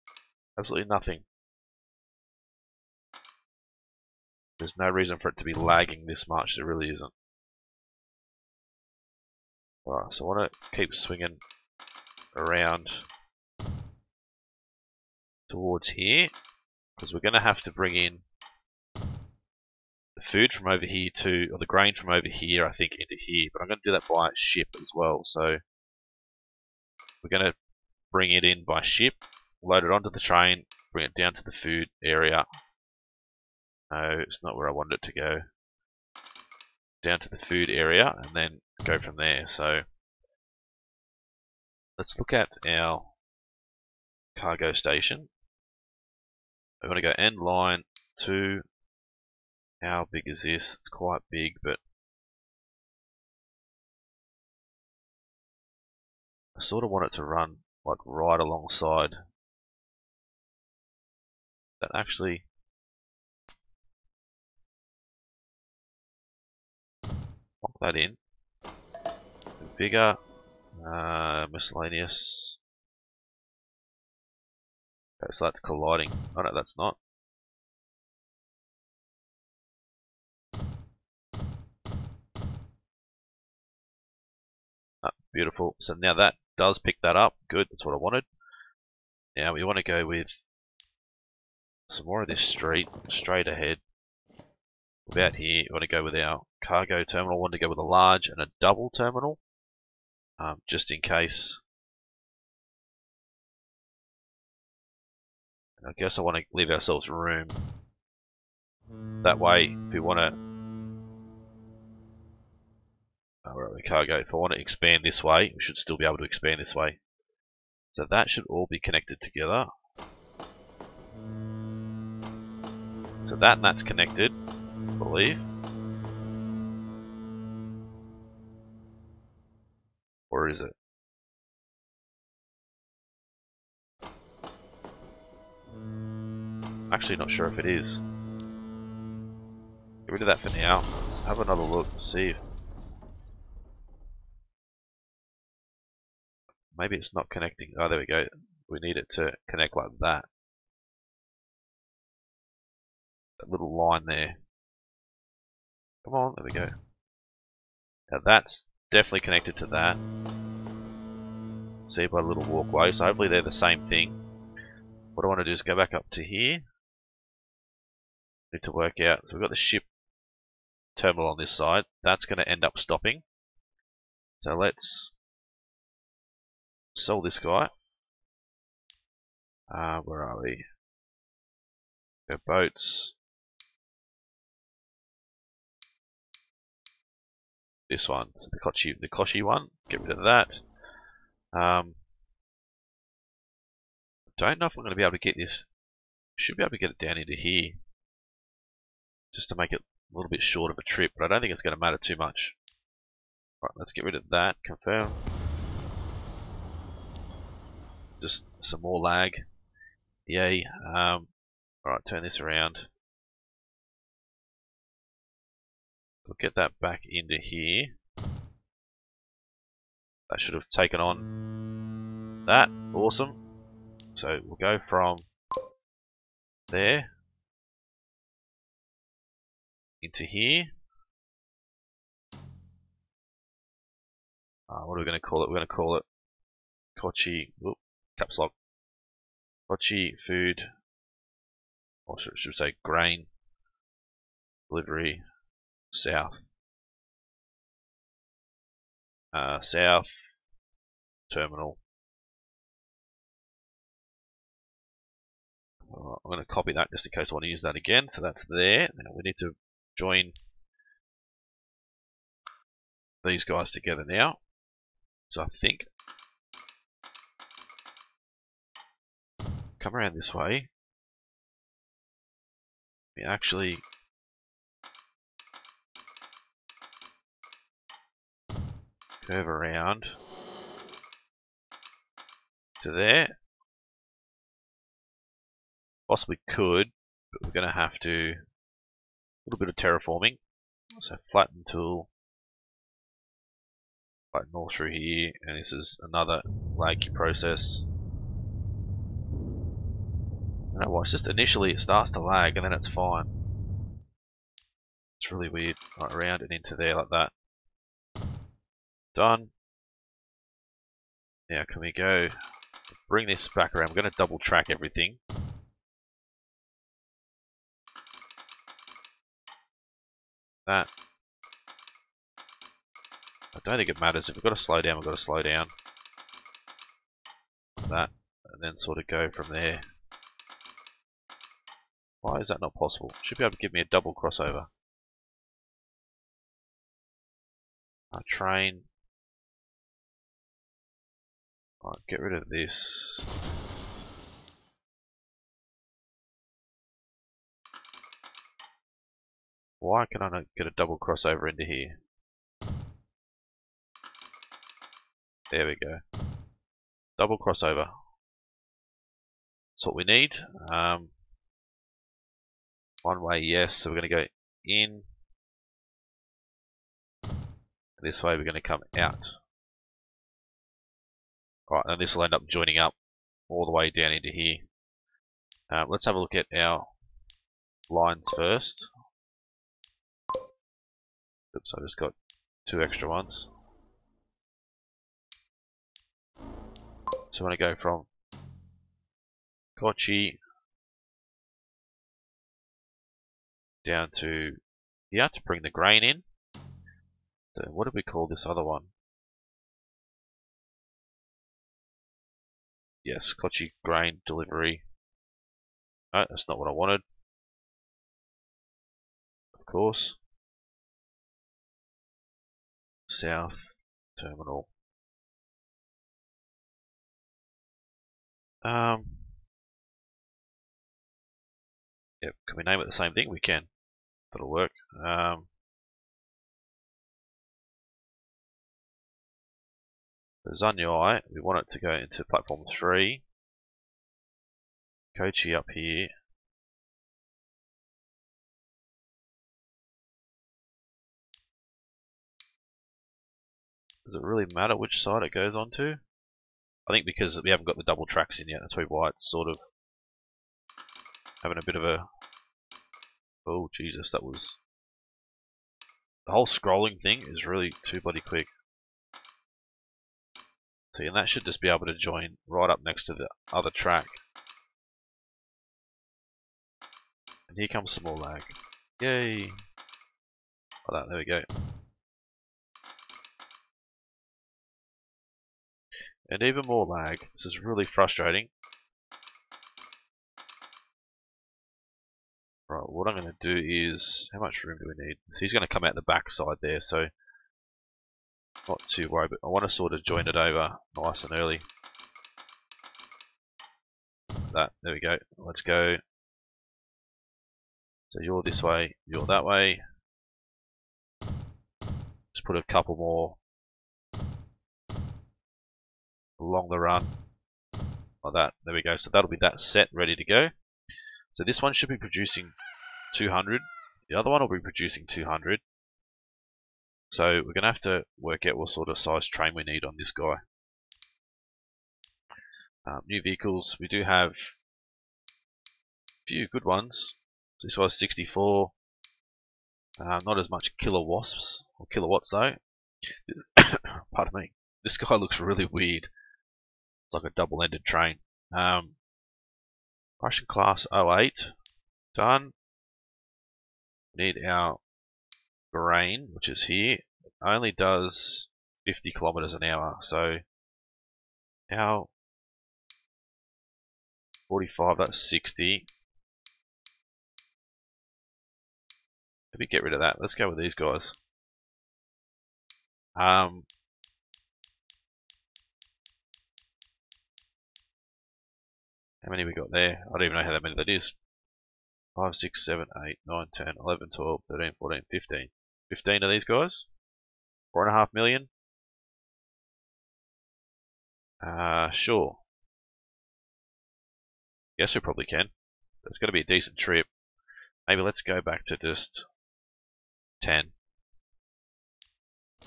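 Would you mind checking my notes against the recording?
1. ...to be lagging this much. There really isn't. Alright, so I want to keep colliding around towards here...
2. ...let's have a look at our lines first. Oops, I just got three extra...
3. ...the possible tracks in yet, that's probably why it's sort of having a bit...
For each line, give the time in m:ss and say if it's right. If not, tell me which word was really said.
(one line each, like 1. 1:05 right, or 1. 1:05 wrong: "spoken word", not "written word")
1. 0:05 wrong: "swinging", not "colliding"
2. 6:15 wrong: "two", not "three"
3. 7:27 wrong: "double", not "possible".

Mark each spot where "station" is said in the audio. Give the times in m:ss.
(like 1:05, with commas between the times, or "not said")
0:44.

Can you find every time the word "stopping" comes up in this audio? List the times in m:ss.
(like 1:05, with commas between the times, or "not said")
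2:52.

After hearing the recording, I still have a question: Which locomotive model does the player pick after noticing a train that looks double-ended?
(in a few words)
Russian class 08.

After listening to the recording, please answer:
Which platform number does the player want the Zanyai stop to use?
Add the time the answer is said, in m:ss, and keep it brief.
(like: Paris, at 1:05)
3, at 7:12.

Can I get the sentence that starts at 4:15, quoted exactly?
Uh, I'm going to copy that just in case I want to use that again.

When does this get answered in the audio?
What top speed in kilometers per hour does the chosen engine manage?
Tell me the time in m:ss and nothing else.
9:08.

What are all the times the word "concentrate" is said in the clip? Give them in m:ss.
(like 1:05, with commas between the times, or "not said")
not said.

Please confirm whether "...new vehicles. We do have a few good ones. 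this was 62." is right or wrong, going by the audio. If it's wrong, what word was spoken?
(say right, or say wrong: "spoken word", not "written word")
wrong: "64", not "62".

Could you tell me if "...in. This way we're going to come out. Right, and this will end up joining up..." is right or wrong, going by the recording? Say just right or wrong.
right.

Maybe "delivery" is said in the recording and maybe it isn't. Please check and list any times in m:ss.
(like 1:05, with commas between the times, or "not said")
4:04, 6:44.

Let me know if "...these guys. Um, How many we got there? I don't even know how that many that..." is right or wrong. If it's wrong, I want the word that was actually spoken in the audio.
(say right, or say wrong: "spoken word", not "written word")
right.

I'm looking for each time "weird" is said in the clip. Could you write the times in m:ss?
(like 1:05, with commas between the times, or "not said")
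5:05, 8:55.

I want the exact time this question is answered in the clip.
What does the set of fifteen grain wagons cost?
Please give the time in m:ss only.
9:37.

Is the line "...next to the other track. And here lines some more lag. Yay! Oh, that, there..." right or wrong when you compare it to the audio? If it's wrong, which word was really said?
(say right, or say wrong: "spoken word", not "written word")
wrong: "comes", not "lines".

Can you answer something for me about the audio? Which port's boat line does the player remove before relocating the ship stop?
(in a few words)
Koshi.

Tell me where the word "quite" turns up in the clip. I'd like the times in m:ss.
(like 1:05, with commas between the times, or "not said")
0:50.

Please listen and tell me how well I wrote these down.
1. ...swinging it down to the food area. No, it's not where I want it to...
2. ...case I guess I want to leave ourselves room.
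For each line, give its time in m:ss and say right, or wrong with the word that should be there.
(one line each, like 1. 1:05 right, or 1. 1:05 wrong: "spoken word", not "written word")
1. 0:30 wrong: "bring", not "swinging"
2. 1:41 right.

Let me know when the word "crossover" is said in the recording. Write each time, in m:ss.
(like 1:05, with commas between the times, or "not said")
5:34, 5:50, 5:57.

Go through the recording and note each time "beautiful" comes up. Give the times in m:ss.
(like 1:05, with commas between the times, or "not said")
1:25.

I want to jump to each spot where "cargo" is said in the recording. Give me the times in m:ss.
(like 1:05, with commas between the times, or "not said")
0:44, 1:36.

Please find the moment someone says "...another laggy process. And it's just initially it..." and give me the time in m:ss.
4:56.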